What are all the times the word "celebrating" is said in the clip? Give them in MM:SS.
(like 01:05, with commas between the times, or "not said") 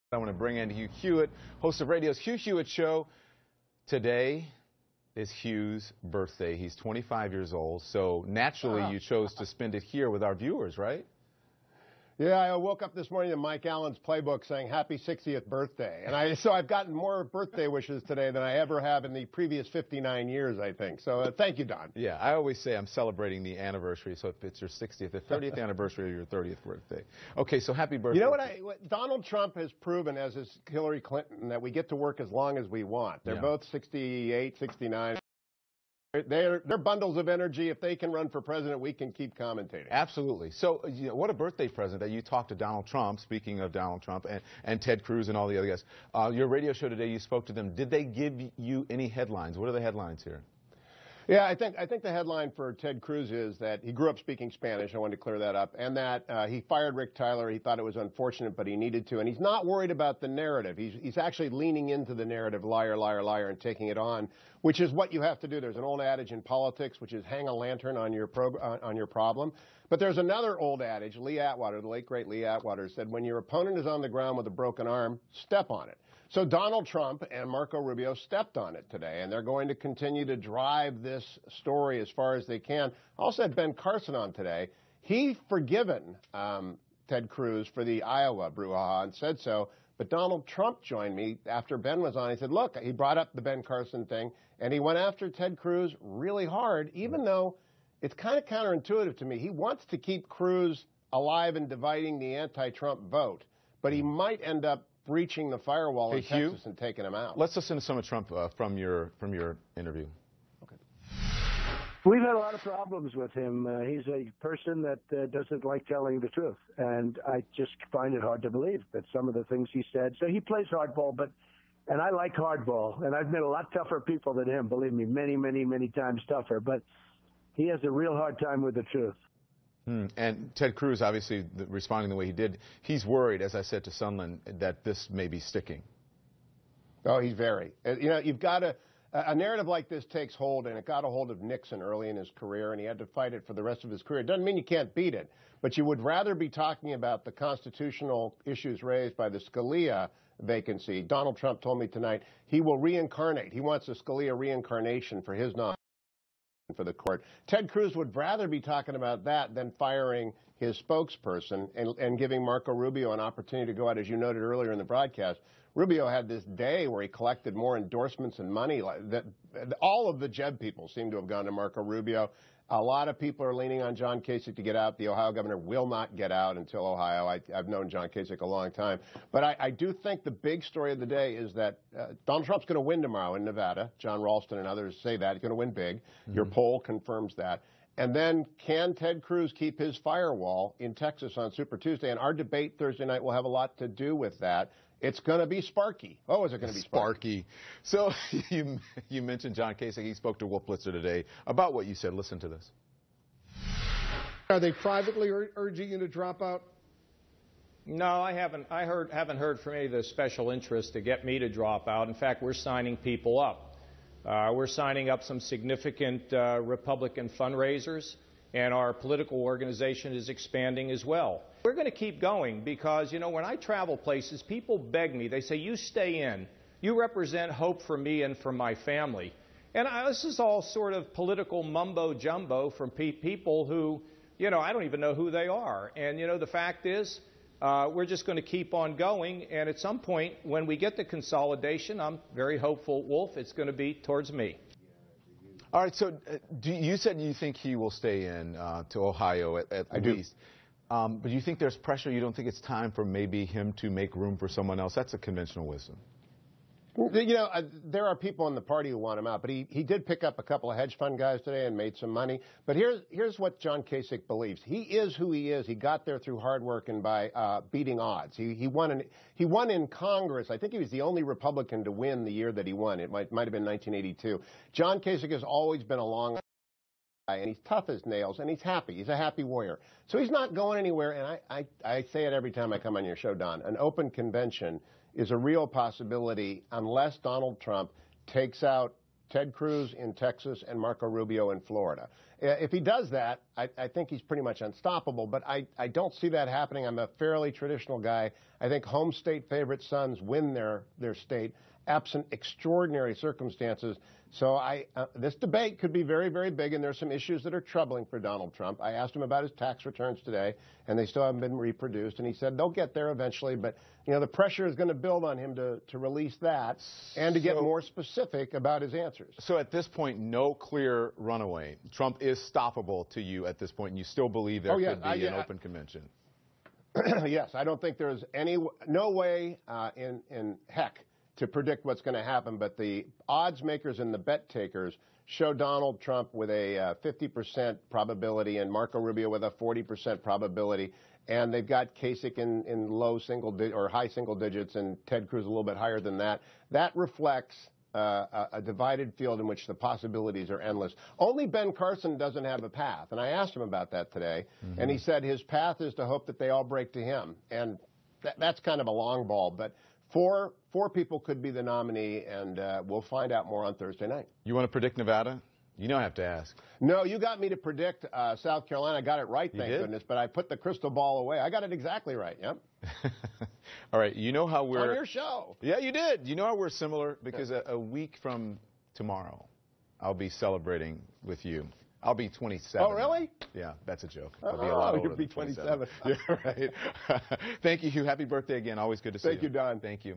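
00:22, 06:20.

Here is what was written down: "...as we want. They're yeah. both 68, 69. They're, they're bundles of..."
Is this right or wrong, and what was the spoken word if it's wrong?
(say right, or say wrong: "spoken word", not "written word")
right.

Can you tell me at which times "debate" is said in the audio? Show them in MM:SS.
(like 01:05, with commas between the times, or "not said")
03:12, 05:05.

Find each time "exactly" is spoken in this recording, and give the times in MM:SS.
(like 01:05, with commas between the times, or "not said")
06:11.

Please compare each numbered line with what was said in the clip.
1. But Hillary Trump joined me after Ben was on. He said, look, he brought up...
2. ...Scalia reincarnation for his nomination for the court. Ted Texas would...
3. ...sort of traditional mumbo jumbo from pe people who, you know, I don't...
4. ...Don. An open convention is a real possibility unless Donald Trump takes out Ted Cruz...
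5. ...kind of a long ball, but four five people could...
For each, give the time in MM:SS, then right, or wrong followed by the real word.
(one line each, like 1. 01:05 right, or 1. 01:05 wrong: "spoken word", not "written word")
1. 01:29 wrong: "Donald", not "Hillary"
2. 02:33 wrong: "Cruz", not "Texas"
3. 03:50 wrong: "political", not "traditional"
4. 04:43 right
5. 05:58 wrong: "four", not "five".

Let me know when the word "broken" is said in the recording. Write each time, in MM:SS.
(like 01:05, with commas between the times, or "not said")
01:14.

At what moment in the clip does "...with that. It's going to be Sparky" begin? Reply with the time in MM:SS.
03:14.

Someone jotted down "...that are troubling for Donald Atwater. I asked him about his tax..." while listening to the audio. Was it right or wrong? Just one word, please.
wrong.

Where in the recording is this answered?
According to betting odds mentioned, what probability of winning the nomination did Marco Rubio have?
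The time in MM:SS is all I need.
05:39.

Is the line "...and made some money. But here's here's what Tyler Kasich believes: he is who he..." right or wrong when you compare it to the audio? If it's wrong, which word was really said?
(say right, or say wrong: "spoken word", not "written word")
wrong: "John", not "Tyler".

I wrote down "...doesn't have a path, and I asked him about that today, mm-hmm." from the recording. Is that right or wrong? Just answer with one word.
right.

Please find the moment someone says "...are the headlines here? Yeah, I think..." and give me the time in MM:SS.
00:49.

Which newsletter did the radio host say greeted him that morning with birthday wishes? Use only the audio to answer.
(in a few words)
Mike Allen's playbook.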